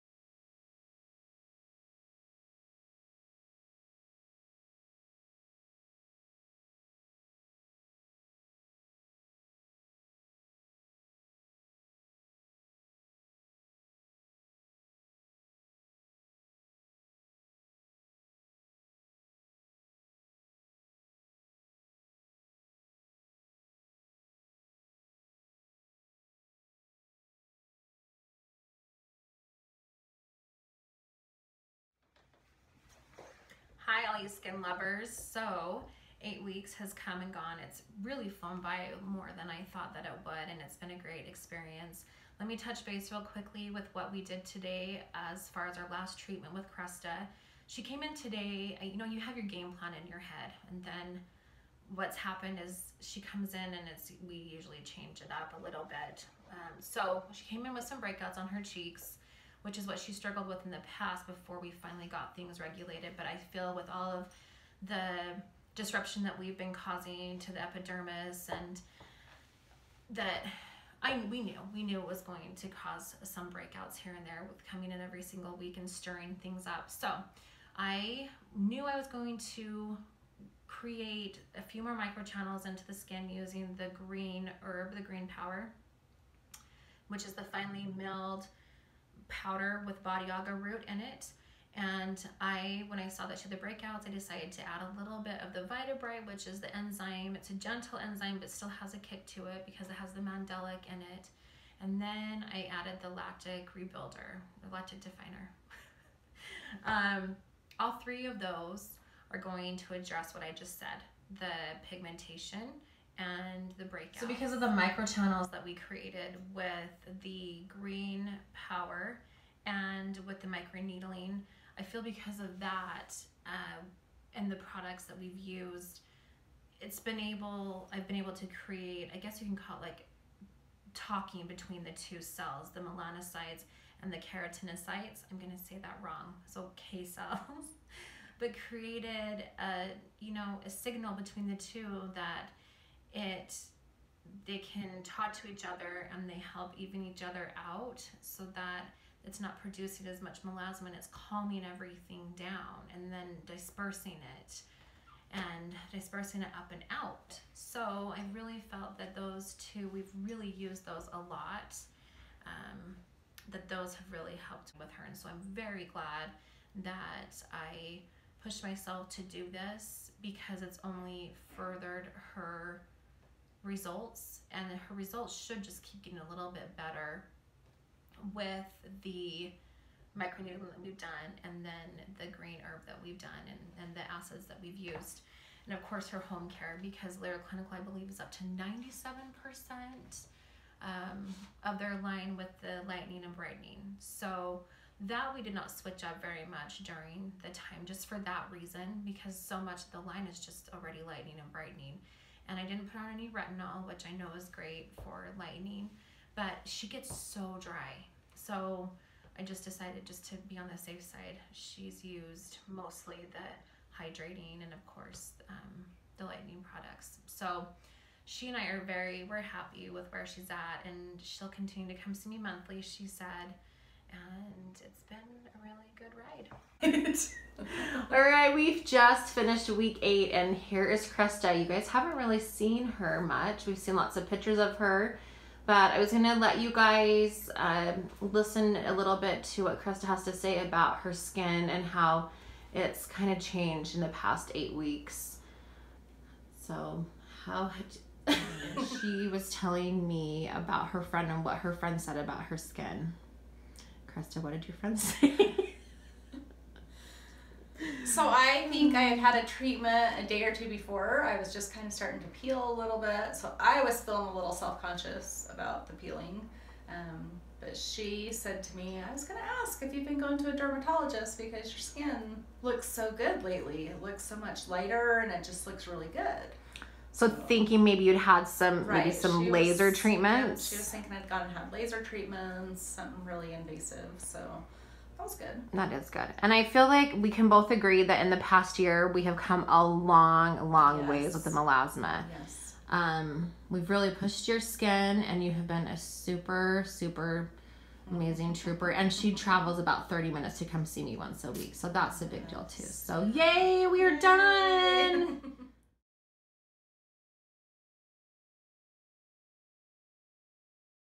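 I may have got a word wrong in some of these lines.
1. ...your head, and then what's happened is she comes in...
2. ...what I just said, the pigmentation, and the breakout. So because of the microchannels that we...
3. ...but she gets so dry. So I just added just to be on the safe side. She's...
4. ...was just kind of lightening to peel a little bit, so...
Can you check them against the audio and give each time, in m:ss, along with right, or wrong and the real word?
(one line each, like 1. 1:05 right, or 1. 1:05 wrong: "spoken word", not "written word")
1. 0:50 right
2. 1:50 right
3. 3:26 wrong: "decided", not "added"
4. 4:21 wrong: "starting", not "lightening".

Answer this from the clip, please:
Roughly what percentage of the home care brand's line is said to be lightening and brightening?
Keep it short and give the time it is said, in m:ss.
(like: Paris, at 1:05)
97%, at 3:08.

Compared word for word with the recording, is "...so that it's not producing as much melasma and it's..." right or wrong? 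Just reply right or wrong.
right.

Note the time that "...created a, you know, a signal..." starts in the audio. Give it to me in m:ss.
2:18.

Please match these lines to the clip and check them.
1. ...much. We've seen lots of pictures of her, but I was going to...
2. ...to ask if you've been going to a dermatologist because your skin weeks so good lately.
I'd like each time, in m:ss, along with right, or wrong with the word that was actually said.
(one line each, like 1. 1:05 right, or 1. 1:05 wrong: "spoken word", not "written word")
1. 3:53 right
2. 4:29 wrong: "looks", not "weeks".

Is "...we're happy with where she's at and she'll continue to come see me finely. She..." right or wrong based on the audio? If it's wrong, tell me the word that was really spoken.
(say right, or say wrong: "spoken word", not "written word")
wrong: "monthly", not "finely".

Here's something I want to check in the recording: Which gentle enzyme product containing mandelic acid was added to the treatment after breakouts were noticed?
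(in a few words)
vitabrite.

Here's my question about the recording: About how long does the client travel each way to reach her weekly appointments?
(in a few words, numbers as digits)
30 minutes.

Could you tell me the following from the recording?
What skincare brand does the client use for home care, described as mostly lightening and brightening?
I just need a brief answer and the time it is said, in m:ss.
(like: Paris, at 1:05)
Lira Clinical, at 3:07.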